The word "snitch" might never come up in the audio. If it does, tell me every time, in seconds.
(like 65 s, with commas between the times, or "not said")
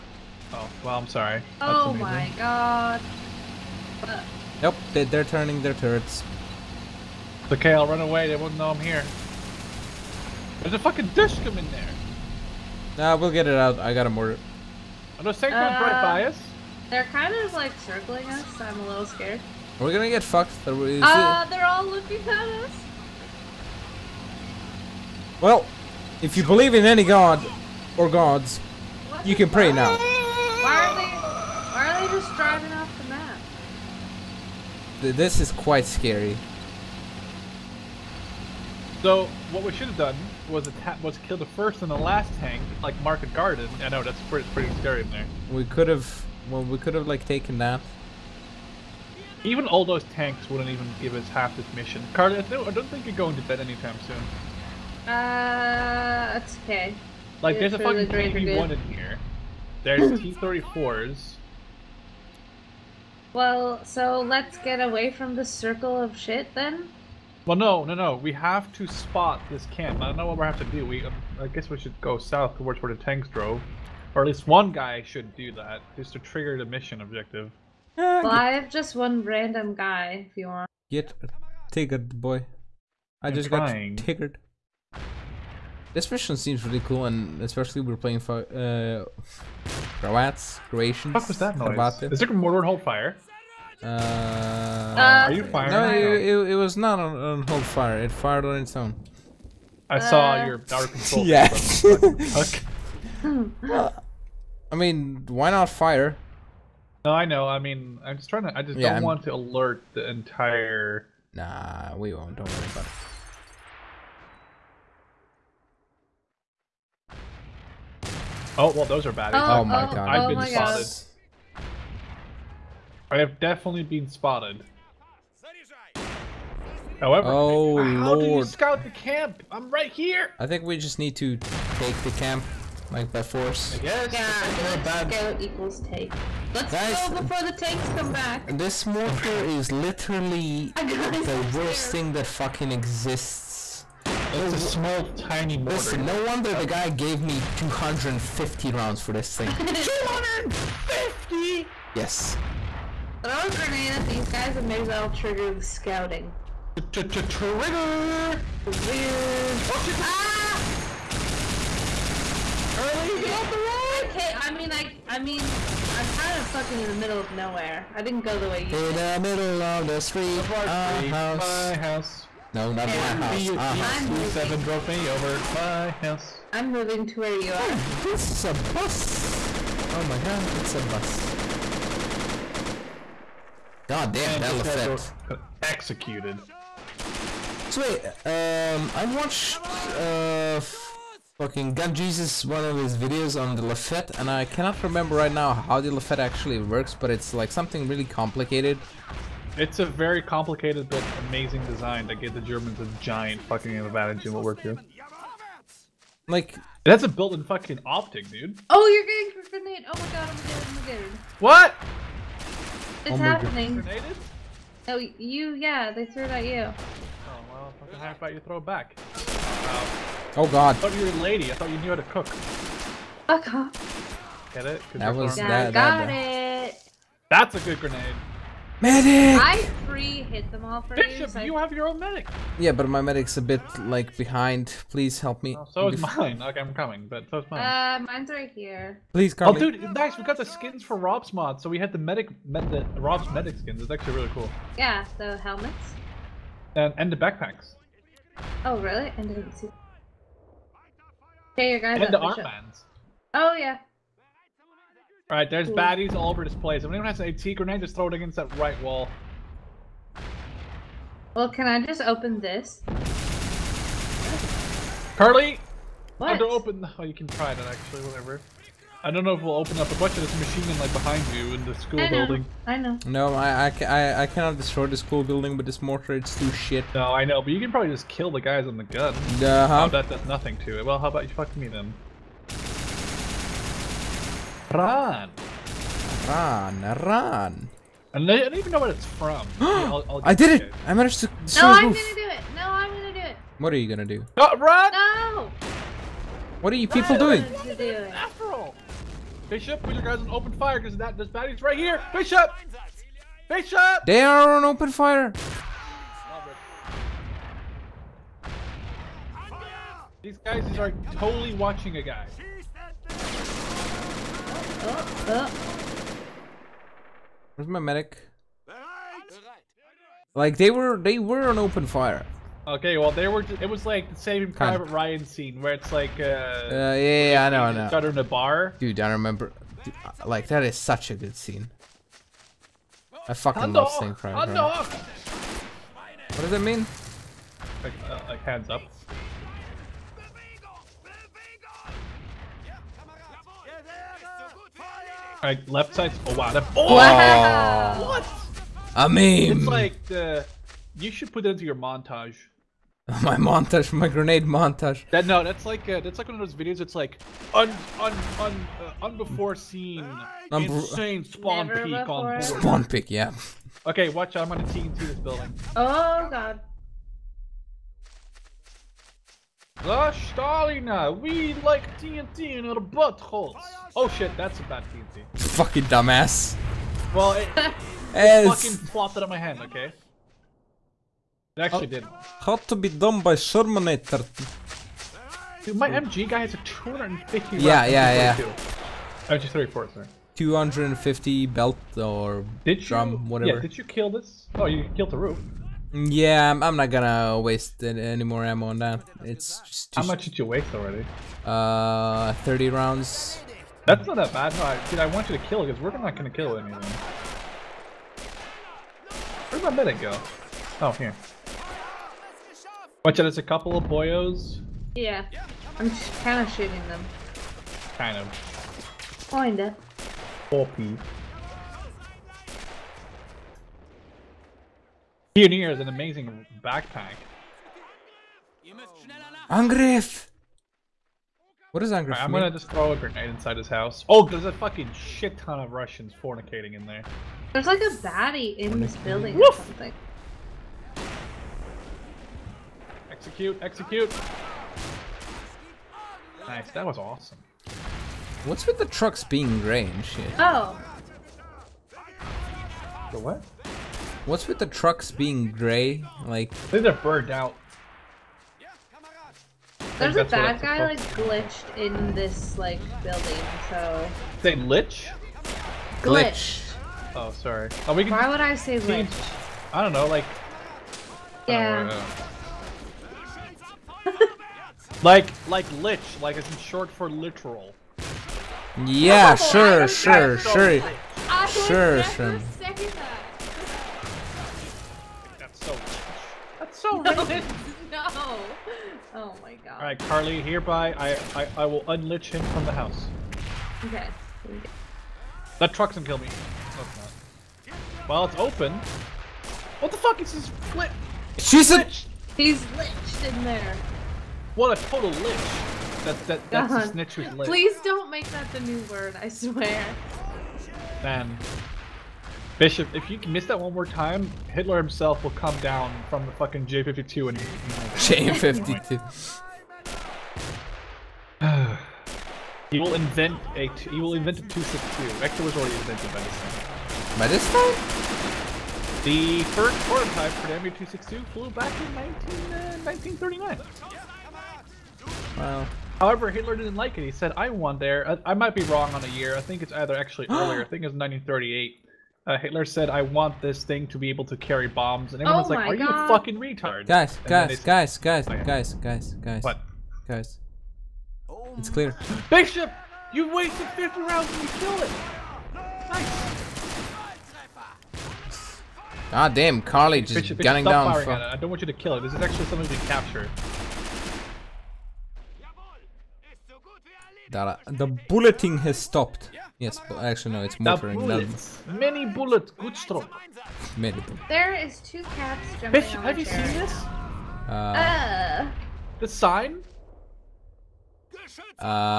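506 s.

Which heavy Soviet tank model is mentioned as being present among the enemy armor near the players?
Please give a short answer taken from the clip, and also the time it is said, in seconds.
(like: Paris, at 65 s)
KV-1, at 58 s.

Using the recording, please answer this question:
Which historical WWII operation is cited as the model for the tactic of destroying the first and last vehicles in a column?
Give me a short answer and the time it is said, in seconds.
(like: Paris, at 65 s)
Market Garden, at 43 s.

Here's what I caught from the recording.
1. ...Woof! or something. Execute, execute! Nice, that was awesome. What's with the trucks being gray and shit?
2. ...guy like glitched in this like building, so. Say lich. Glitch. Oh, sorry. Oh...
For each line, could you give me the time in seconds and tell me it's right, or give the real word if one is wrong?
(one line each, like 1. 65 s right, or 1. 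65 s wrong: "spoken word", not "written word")
1. 439 s right
2. 460 s right.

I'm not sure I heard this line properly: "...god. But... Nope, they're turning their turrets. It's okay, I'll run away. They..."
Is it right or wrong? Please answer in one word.
right.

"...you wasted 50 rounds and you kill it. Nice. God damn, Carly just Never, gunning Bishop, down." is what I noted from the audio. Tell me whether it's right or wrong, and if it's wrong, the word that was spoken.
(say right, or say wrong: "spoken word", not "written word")
wrong: "Bishop", not "Never".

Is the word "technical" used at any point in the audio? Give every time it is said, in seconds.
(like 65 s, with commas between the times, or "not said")
not said.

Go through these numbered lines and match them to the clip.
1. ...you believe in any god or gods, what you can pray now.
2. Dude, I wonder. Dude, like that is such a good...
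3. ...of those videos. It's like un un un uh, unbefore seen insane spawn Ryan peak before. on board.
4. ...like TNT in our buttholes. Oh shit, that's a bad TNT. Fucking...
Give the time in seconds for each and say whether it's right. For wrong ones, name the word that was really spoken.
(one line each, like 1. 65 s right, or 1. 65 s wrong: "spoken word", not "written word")
1. 26 s right
2. 328 s wrong: "remember", not "wonder"
3. 356 s wrong: "Never", not "Ryan"
4. 371 s right.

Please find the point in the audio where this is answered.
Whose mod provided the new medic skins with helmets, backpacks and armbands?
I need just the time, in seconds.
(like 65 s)
240 s.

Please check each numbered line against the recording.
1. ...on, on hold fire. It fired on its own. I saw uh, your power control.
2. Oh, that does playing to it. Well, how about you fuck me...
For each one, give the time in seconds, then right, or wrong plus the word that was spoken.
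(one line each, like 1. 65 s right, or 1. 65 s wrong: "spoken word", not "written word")
1. 96 s right
2. 279 s wrong: "nothing", not "playing".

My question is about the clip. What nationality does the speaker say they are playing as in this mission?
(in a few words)
Croatians.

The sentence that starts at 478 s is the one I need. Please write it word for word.
Yeah, sure, sure, sure, sure, sure.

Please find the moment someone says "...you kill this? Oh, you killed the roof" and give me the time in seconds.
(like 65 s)
393 s.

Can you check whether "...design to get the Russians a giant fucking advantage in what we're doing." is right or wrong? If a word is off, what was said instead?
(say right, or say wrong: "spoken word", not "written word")
wrong: "Germans", not "Russians".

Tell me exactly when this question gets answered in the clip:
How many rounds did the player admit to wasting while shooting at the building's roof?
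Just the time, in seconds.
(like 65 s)
402 s.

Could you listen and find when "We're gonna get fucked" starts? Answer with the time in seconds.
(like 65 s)
19 s.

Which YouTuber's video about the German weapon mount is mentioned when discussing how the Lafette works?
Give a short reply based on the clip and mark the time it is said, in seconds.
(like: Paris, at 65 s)
Gun Jesus, at 191 s.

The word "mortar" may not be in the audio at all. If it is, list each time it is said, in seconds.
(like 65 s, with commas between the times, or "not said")
14 s, 138 s, 145 s, 275 s, 570 s.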